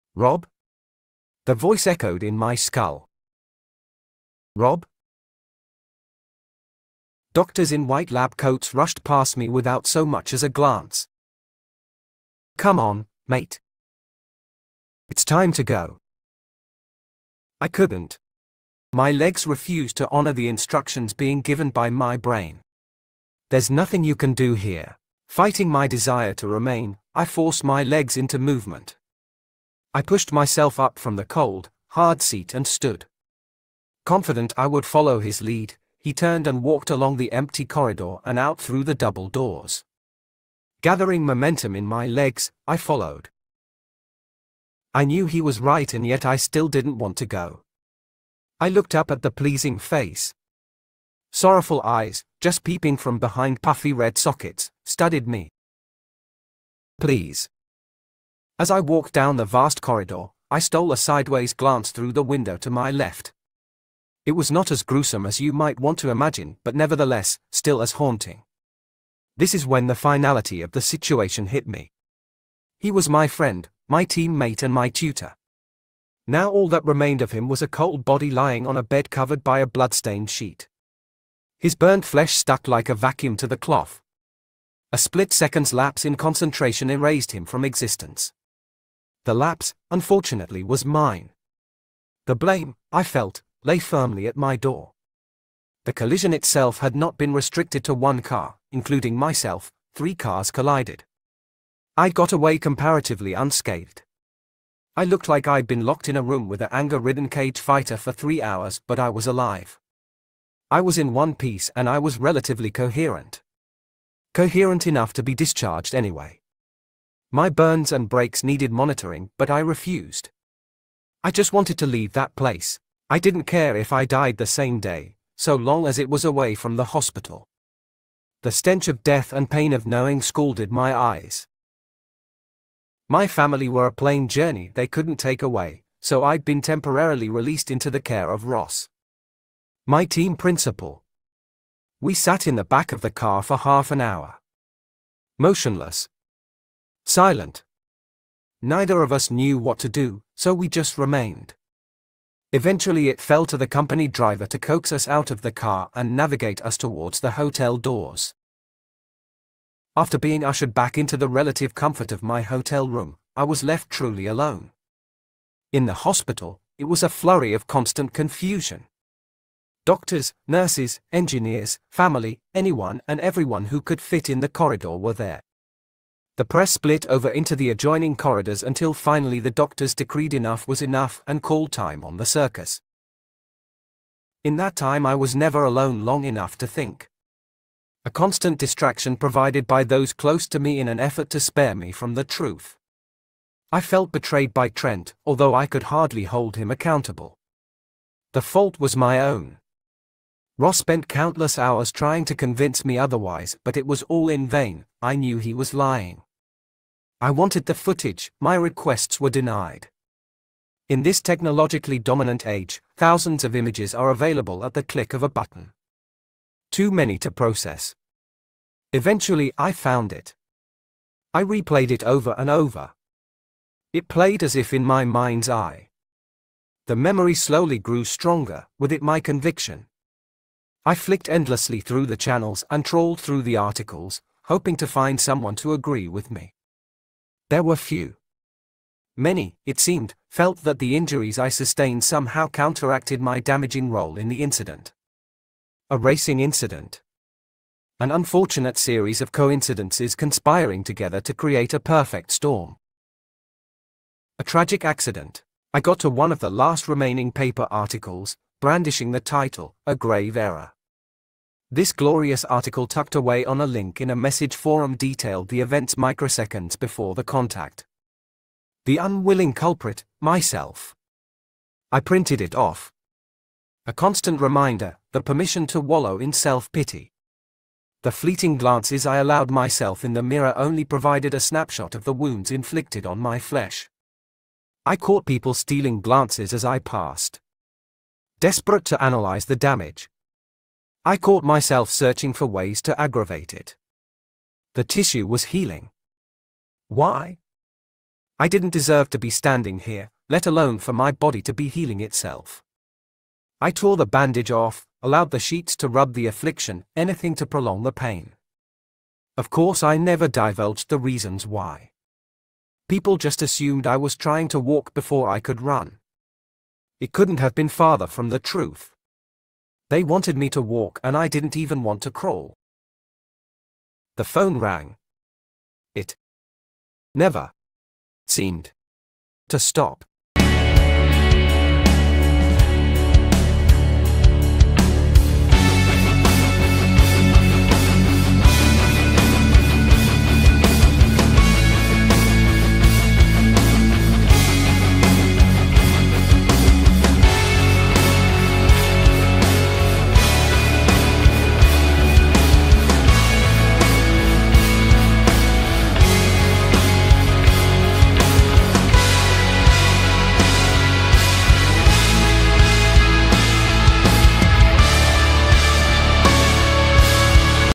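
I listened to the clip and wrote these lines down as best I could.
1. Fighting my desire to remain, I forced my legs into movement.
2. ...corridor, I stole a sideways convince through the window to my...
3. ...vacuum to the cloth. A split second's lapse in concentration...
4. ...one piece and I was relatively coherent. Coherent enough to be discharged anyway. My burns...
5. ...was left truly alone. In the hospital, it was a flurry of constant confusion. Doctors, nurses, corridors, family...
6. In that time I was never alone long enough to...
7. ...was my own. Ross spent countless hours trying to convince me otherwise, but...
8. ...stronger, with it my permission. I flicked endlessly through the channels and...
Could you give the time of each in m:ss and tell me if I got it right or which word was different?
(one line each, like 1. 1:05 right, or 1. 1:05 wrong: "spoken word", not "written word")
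1. 0:25 right
2. 0:59 wrong: "glance", not "convince"
3. 1:22 right
4. 1:51 right
5. 2:43 wrong: "engineers", not "corridors"
6. 3:04 right
7. 3:18 right
8. 3:48 wrong: "conviction", not "permission".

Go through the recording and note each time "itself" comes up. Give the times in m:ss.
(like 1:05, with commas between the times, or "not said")
1:36, 5:02.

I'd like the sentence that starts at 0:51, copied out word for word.
Sorrowful eyes, just peeping from behind puffy red sockets, studied me.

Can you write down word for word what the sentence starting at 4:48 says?
Desperate to analyze the damage, I caught myself searching for ways to aggravate it.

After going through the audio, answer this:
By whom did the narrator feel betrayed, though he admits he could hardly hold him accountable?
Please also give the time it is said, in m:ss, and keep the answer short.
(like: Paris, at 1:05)
Trent, at 3:14.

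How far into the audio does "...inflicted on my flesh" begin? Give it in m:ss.
4:42.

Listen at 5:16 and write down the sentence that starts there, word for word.
It couldn't have been farther from the truth.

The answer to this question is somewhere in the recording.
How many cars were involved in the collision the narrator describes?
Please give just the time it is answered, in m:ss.
1:39.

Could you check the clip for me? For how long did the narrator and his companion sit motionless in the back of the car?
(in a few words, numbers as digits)
Half an hour.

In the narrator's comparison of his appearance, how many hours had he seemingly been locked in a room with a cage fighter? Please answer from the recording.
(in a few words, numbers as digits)
3.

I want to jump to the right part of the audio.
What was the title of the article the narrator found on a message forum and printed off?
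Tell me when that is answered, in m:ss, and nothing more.
4:19.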